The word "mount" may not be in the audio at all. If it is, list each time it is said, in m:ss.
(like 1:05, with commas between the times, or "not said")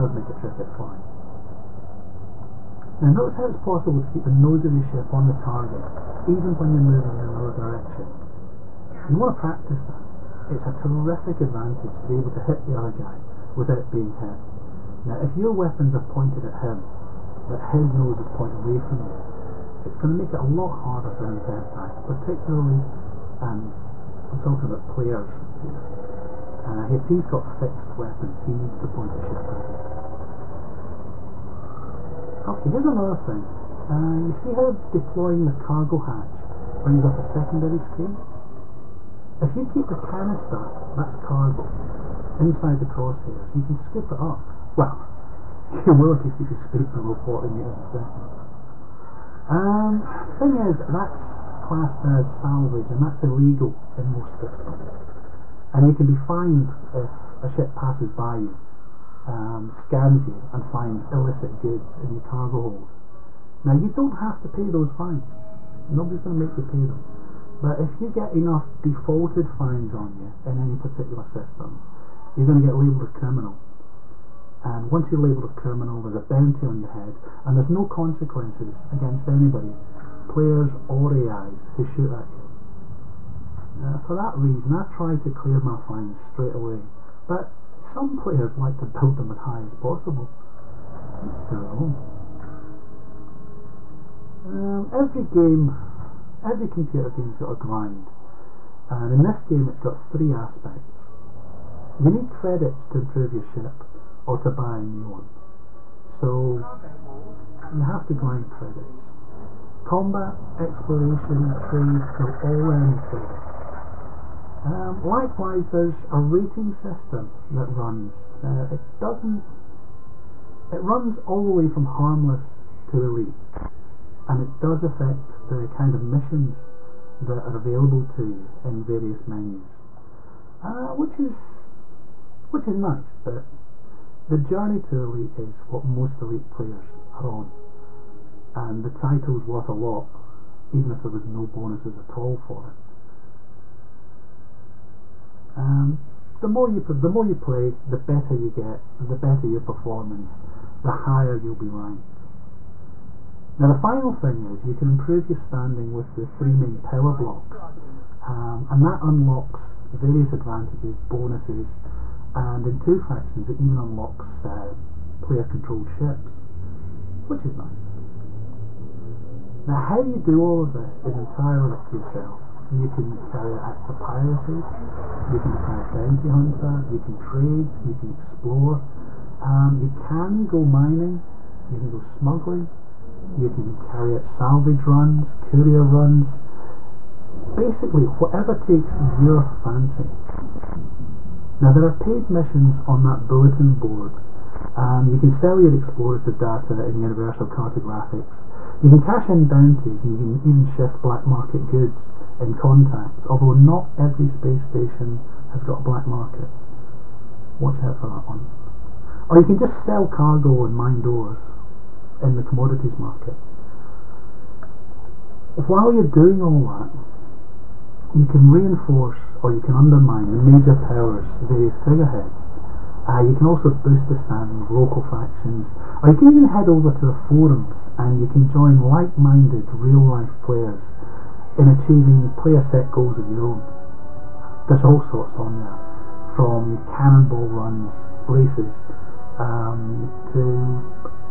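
not said.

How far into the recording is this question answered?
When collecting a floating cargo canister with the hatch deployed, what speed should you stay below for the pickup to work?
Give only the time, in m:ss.
0:47.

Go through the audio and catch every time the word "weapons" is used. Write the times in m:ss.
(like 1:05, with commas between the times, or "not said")
0:15, 0:27.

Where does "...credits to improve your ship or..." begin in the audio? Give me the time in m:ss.
1:42.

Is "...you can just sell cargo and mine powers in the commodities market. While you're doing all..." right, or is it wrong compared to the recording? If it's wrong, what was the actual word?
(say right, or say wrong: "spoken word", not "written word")
wrong: "doors", not "powers".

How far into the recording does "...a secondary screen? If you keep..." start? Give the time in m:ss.
0:37.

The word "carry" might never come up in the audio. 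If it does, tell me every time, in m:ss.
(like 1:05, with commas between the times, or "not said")
2:53, 3:03.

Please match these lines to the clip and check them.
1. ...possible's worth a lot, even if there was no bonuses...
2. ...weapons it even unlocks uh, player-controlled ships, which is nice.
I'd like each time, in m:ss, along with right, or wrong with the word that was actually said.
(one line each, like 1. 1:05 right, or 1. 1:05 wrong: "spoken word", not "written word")
1. 2:18 wrong: "title", not "possible"
2. 2:42 wrong: "factions", not "weapons".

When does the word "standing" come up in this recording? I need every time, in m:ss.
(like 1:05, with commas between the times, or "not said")
2:35, 3:44.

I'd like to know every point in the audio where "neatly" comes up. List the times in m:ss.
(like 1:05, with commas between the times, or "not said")
not said.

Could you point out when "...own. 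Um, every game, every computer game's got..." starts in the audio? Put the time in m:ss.
1:31.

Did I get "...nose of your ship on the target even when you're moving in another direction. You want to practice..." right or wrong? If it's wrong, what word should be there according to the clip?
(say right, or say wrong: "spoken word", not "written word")
right.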